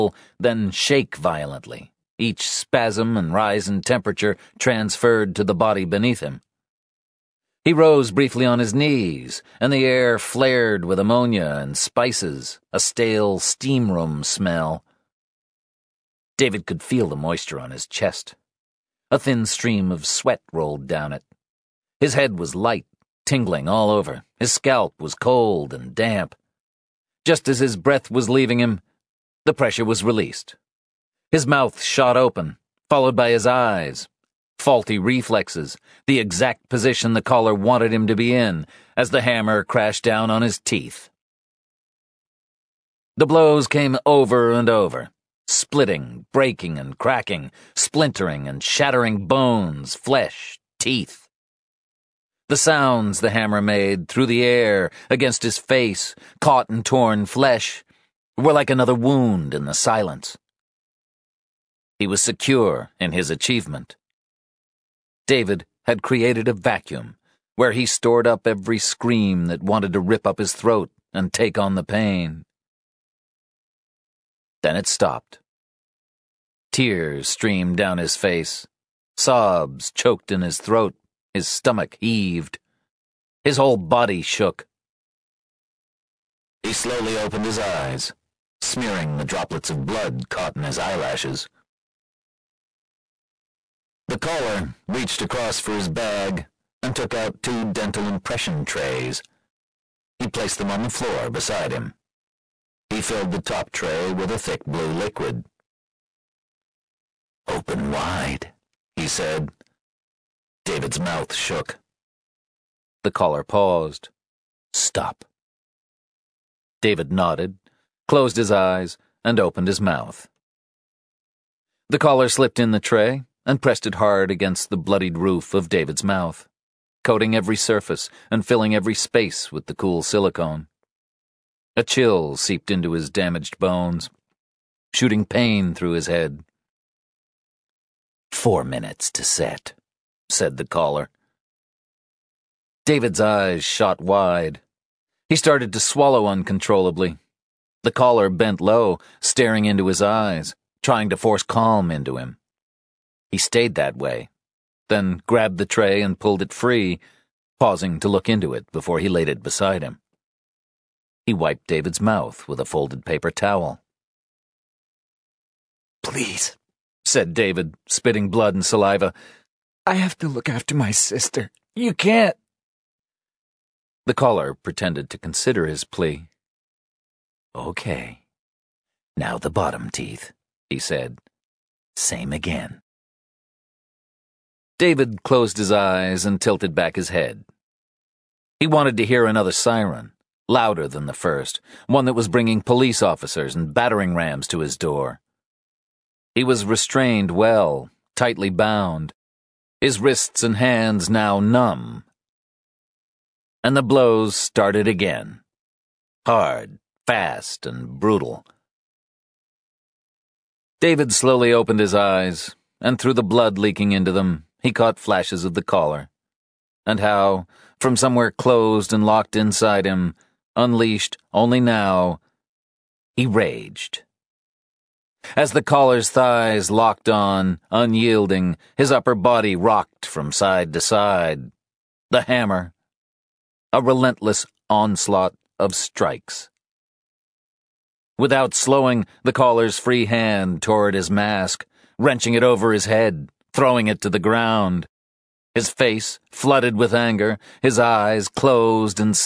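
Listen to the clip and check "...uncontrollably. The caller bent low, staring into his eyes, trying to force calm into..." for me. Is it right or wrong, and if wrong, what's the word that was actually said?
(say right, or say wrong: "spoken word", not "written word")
right.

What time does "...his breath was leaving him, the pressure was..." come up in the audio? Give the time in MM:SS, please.
00:27.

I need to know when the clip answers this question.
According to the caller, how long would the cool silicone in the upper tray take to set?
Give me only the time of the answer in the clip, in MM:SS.
02:18.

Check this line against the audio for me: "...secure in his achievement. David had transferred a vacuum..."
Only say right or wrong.
wrong.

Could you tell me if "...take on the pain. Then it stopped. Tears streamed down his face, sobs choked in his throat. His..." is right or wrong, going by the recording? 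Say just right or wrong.
right.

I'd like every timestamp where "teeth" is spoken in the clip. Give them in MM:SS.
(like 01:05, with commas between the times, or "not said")
00:40, 00:50, 02:59.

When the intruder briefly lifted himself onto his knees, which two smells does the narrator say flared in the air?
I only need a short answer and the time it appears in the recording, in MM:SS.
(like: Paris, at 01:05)
ammonia and spices, at 00:10.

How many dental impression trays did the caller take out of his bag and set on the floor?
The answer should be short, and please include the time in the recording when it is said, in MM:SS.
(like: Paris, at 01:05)
2, at 01:37.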